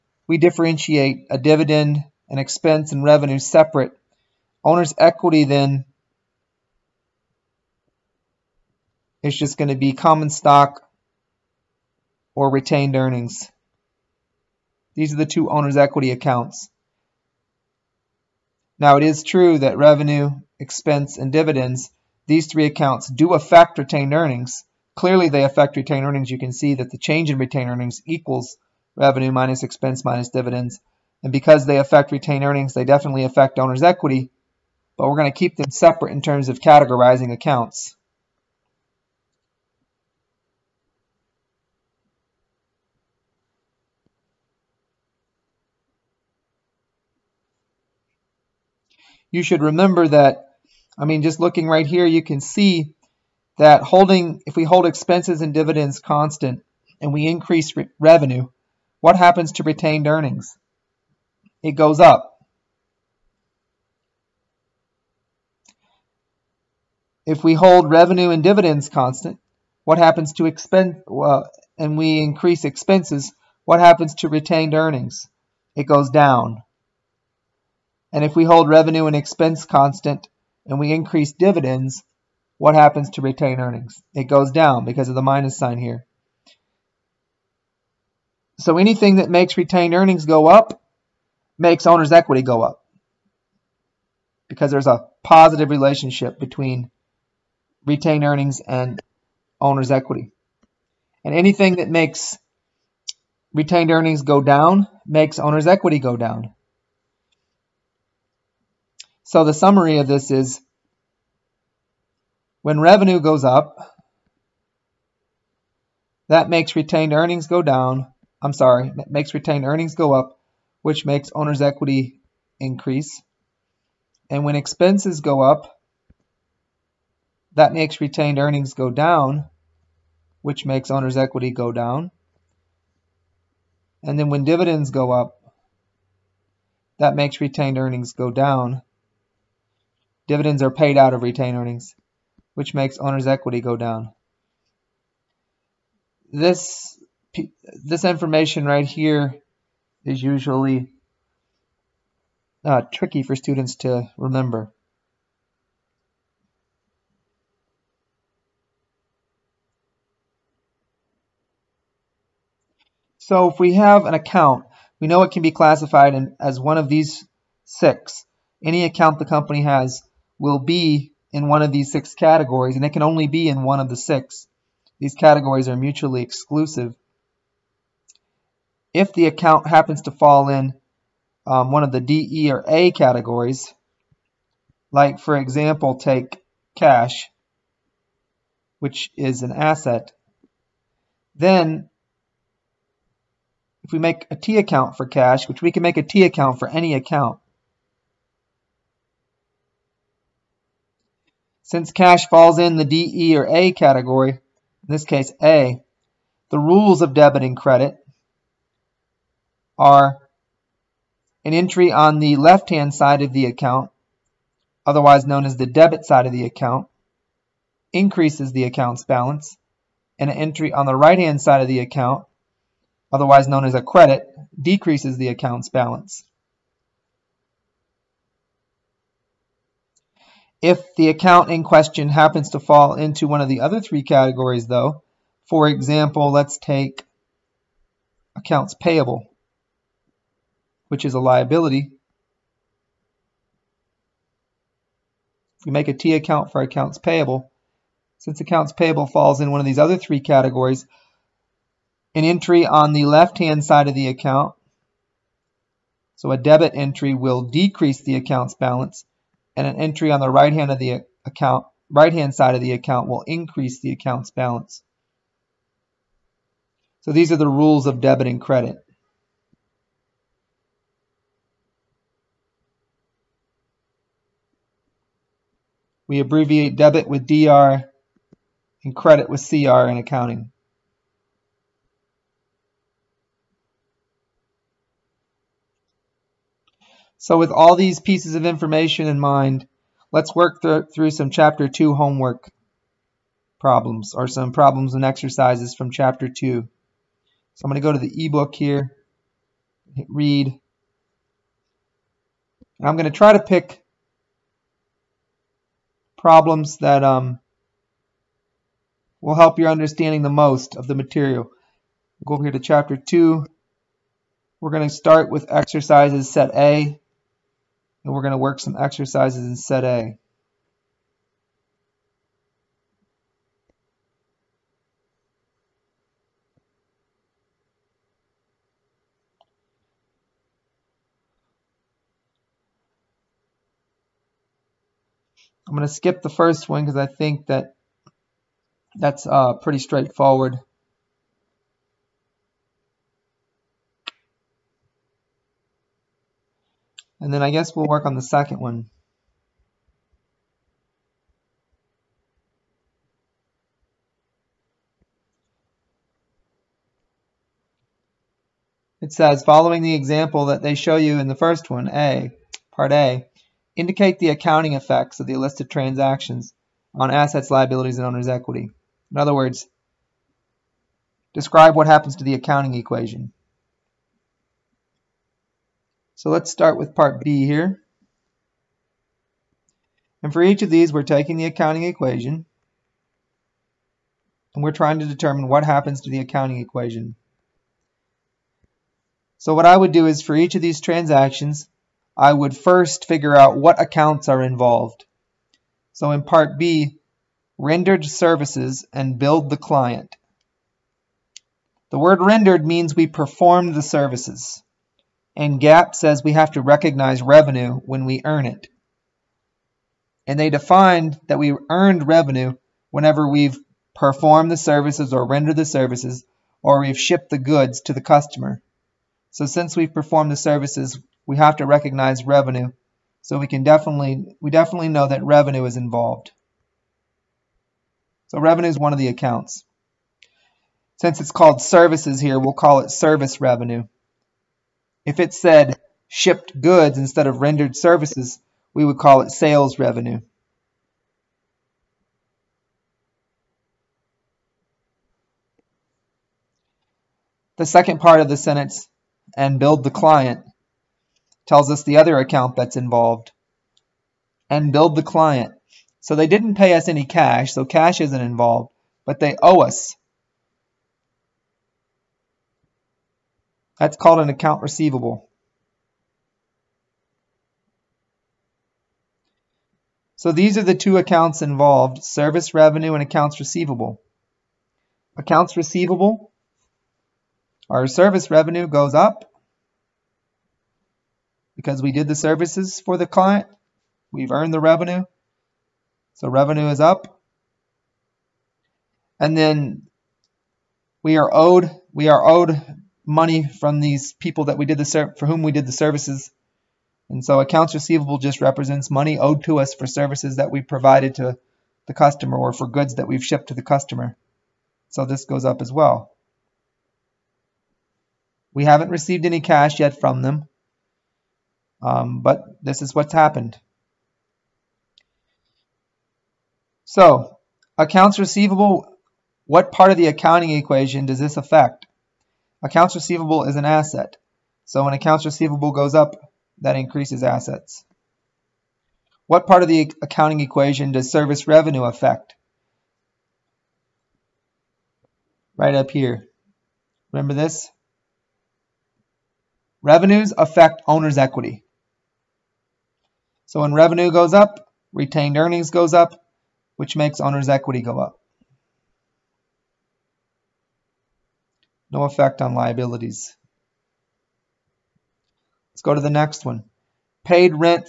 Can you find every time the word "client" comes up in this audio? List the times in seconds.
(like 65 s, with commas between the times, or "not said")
399 s, 449 s, 455 s, 483 s.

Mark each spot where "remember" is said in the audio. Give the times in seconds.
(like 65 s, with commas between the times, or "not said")
49 s, 154 s, 537 s.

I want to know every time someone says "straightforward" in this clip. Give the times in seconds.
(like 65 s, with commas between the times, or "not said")
339 s.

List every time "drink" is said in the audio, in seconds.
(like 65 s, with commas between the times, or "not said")
not said.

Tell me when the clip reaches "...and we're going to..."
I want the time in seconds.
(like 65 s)
318 s.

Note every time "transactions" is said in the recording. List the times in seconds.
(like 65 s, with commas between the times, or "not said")
365 s, 390 s.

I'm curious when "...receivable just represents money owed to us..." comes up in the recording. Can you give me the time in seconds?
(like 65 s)
497 s.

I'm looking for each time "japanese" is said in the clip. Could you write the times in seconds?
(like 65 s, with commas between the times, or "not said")
not said.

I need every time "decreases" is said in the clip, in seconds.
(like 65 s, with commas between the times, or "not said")
224 s, 257 s.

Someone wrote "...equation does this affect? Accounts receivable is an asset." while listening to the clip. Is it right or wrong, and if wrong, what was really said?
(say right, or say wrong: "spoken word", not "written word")
right.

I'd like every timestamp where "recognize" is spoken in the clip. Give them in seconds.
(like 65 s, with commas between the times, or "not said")
406 s, 421 s.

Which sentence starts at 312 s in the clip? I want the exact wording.
We'll go over here to Chapter 2.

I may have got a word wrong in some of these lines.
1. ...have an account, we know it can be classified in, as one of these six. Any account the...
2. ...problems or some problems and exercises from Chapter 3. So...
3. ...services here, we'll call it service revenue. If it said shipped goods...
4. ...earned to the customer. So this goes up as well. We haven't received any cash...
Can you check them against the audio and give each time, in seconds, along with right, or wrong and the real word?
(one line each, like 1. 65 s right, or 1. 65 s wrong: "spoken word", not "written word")
1. 163 s right
2. 293 s wrong: "2", not "3"
3. 431 s right
4. 503 s wrong: "shipped", not "earned".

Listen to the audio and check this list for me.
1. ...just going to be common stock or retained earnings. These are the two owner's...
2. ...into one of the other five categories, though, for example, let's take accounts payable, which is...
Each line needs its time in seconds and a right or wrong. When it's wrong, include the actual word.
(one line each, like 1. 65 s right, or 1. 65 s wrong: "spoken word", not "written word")
1. 9 s right
2. 232 s wrong: "three", not "five".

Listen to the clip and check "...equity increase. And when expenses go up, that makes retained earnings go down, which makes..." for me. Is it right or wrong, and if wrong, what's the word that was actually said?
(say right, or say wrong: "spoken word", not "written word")
right.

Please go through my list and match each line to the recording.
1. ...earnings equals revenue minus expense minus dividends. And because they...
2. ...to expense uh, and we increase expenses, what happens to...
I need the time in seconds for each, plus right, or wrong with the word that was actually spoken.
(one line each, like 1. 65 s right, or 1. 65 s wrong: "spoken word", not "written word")
1. 27 s right
2. 70 s right.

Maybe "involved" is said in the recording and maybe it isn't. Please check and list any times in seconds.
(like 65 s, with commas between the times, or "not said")
394 s, 425 s, 452 s, 458 s, 471 s.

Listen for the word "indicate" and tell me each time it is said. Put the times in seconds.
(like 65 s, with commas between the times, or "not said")
363 s.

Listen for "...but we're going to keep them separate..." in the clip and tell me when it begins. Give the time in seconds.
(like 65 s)
34 s.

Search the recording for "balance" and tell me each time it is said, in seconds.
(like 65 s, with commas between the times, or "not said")
219 s, 225 s, 258 s, 264 s.